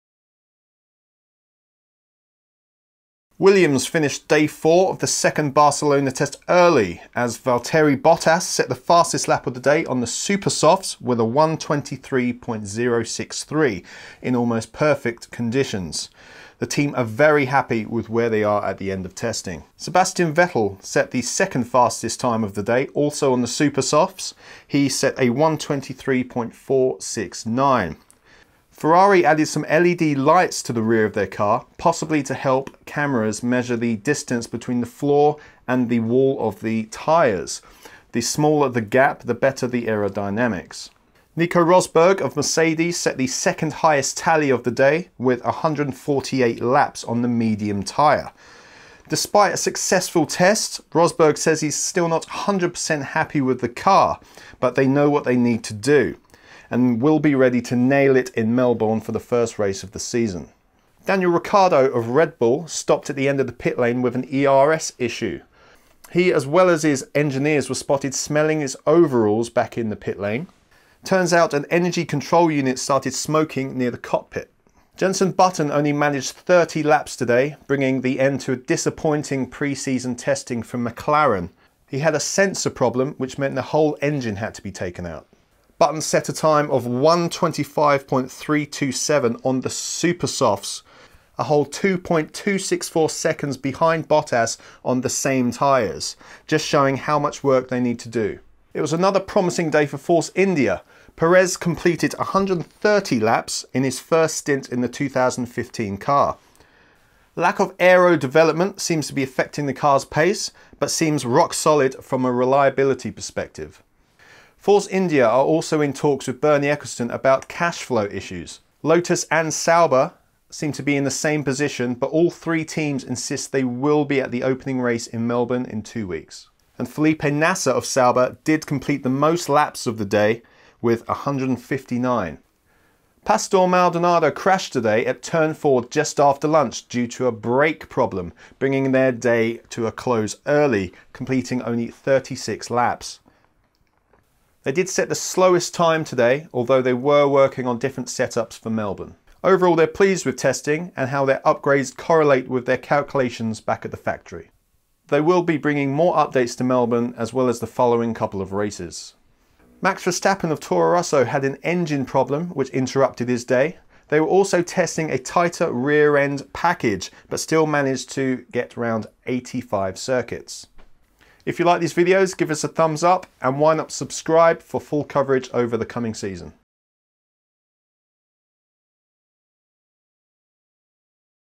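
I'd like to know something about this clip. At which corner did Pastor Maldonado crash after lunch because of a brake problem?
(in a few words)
Turn 4.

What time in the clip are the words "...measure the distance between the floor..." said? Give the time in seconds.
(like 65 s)
33 s.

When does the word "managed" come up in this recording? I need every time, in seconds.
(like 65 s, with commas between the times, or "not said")
75 s, 167 s.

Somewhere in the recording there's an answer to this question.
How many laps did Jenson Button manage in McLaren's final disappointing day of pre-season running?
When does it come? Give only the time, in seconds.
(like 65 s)
76 s.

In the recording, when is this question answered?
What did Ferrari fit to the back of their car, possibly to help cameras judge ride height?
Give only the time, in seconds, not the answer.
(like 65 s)
29 s.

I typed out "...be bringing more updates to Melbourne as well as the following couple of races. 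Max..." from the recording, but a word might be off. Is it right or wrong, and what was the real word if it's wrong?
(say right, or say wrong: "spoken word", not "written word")
right.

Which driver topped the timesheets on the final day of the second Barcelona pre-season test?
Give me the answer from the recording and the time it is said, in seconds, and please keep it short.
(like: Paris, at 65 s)
Valtteri Bottas, at 7 s.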